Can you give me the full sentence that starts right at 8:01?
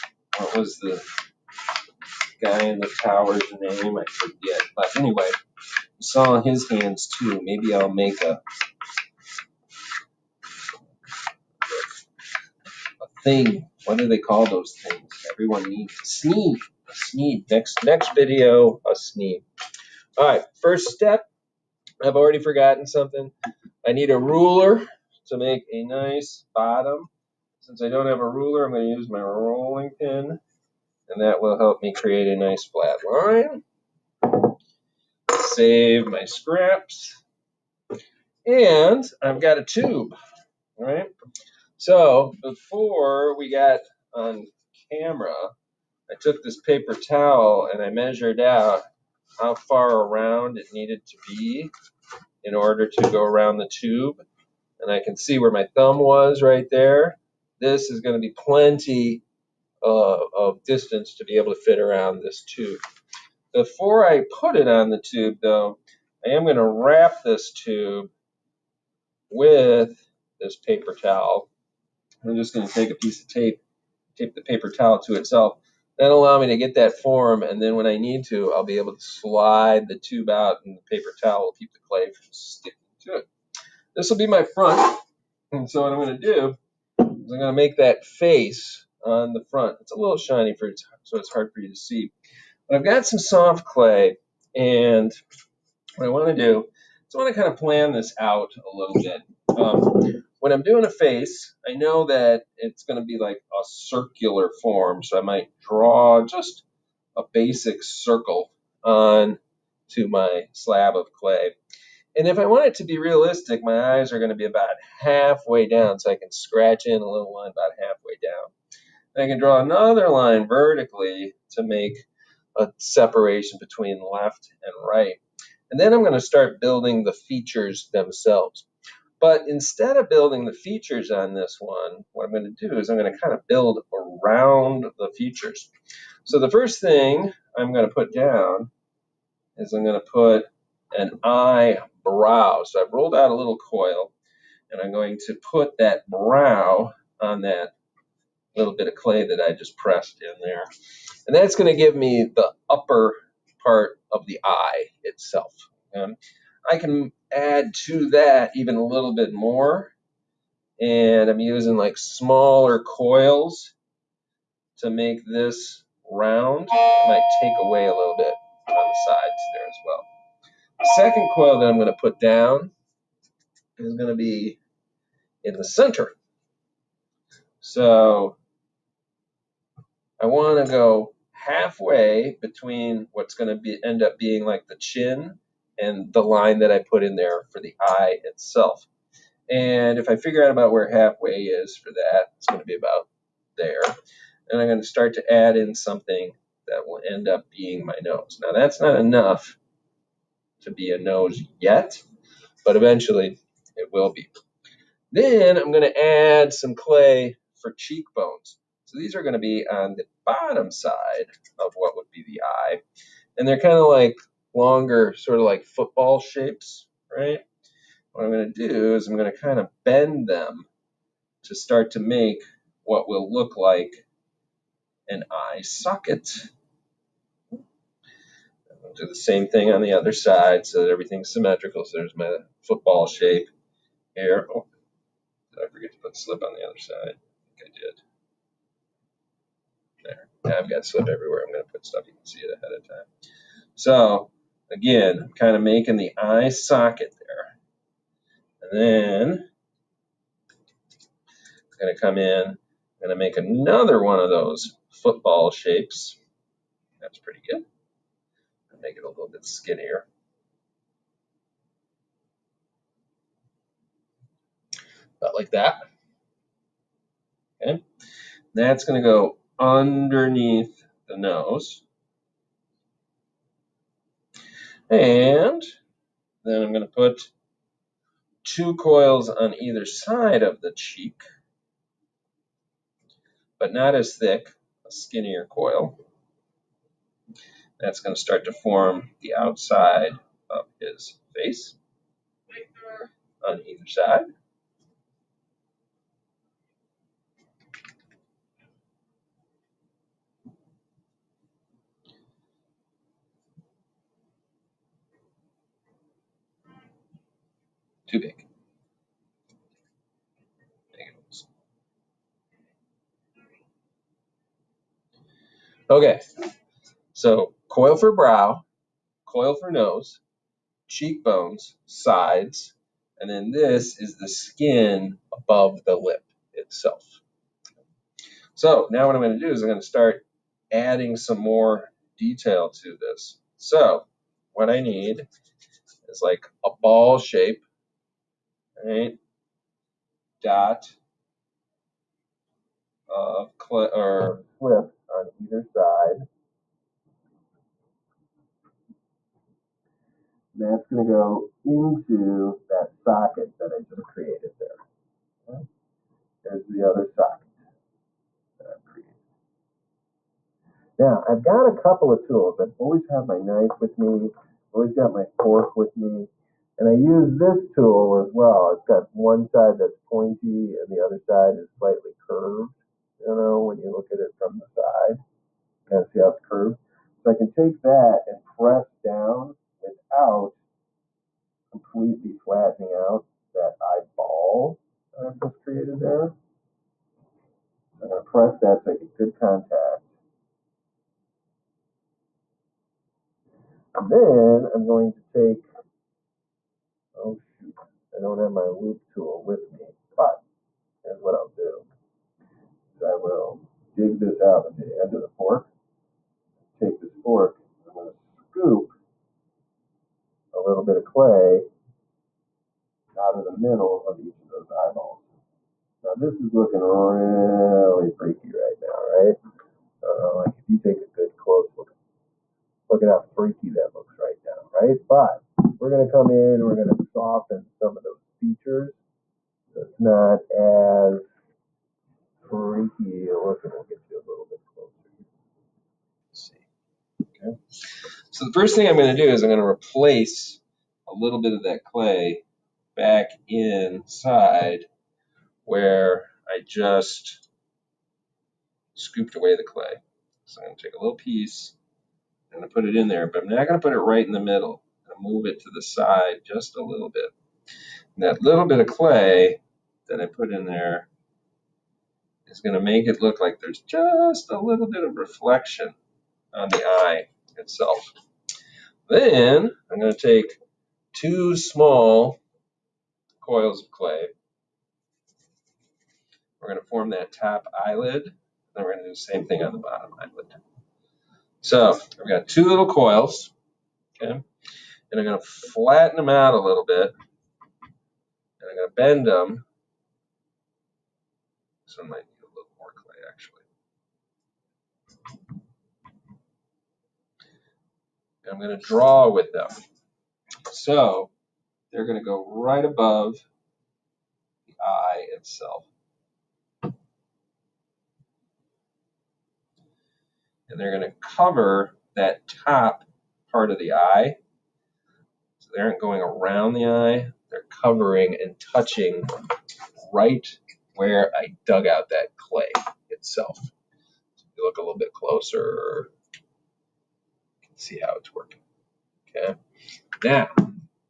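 So i have got two little coils.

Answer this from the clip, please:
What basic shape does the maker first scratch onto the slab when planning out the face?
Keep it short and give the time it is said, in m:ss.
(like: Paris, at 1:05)
circle, at 1:47.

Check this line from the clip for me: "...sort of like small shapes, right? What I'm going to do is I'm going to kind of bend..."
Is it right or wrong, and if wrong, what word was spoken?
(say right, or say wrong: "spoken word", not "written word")
wrong: "football", not "small".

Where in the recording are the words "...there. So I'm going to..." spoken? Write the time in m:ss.
6:25.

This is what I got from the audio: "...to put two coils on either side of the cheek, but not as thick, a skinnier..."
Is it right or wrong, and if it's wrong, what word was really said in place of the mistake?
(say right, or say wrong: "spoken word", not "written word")
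right.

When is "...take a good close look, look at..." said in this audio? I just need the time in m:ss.
7:00.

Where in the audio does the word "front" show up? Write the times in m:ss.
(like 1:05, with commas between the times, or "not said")
1:24, 1:29.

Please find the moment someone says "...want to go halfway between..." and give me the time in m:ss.
3:00.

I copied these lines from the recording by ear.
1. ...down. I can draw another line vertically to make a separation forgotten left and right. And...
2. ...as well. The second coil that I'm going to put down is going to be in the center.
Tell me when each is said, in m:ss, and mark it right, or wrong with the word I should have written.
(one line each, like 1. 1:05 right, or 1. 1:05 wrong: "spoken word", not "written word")
1. 1:58 wrong: "between", not "forgotten"
2. 2:49 right.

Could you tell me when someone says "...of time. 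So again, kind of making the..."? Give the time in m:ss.
4:02.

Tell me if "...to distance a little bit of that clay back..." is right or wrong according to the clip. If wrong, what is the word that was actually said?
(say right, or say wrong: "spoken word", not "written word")
wrong: "replace", not "distance".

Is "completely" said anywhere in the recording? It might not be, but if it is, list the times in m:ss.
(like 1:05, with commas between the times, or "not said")
6:21.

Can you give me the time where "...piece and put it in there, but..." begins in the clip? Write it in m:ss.
7:31.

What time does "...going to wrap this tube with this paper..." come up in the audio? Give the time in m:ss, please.
1:06.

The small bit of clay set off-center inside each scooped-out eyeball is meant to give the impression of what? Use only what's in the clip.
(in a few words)
reflection.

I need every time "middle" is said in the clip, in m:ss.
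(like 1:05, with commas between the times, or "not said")
6:53, 7:34.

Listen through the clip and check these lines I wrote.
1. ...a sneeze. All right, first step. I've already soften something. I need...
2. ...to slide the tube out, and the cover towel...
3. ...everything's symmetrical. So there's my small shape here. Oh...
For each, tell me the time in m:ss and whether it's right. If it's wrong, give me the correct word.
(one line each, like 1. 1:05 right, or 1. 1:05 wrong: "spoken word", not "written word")
1. 0:18 wrong: "forgotten", not "soften"
2. 1:18 wrong: "paper", not "cover"
3. 3:50 wrong: "football", not "small".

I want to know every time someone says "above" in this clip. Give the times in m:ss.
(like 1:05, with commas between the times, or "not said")
5:25, 8:22.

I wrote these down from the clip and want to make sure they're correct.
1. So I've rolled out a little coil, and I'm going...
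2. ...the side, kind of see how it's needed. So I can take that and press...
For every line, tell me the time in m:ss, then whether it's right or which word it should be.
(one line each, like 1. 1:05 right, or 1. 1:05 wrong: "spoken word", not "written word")
1. 2:22 right
2. 6:14 wrong: "curved", not "needed".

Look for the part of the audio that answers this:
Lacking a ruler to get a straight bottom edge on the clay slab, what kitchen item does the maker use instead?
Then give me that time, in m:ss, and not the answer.
0:29.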